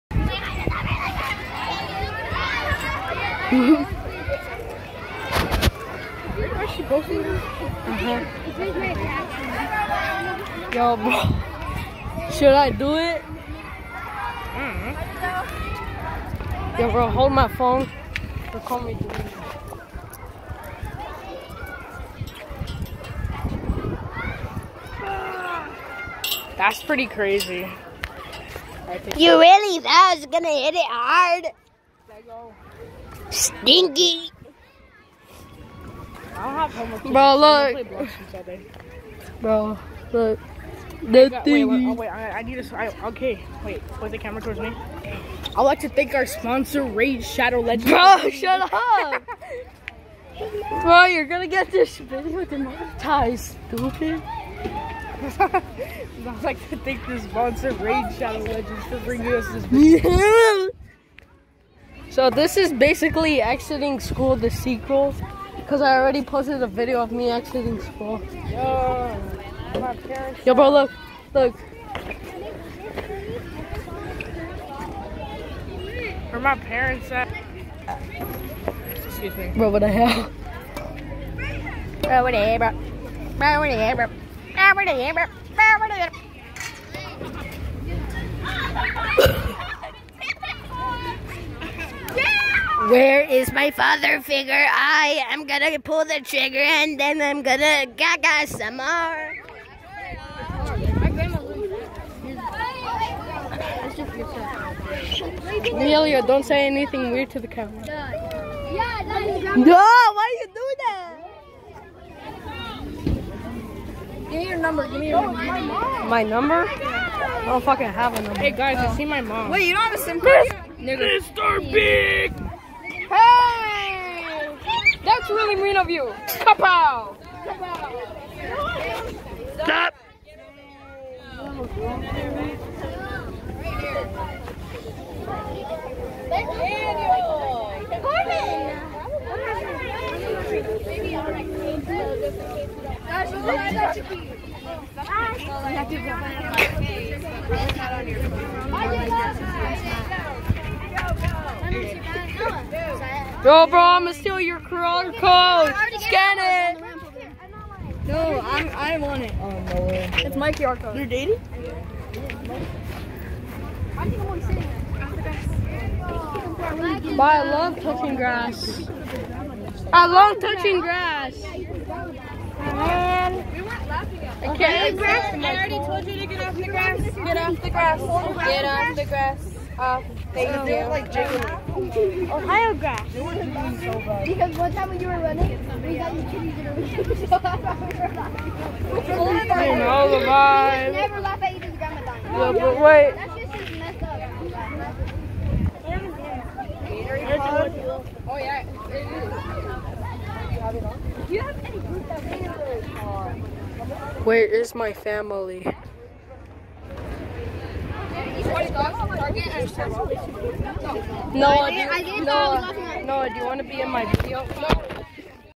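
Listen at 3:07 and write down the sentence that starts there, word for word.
So that's why we were laughing.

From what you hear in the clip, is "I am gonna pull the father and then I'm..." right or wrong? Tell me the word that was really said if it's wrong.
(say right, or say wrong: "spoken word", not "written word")
wrong: "trigger", not "father".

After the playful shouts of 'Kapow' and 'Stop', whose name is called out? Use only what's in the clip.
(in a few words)
Corbin.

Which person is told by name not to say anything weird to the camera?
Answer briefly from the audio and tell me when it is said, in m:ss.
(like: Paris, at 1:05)
Amelia, at 1:45.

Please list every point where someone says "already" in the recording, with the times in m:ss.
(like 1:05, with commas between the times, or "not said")
1:05, 2:55.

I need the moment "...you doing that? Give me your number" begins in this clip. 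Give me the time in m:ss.
1:50.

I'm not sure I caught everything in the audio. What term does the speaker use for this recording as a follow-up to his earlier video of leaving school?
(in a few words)
the sequel.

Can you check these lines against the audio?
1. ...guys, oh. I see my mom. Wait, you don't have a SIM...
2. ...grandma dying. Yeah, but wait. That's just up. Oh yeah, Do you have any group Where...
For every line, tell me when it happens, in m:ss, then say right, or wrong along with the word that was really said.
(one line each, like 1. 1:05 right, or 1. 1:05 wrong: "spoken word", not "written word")
1. 1:58 right
2. 3:11 right.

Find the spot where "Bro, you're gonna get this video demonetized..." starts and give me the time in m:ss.
0:50.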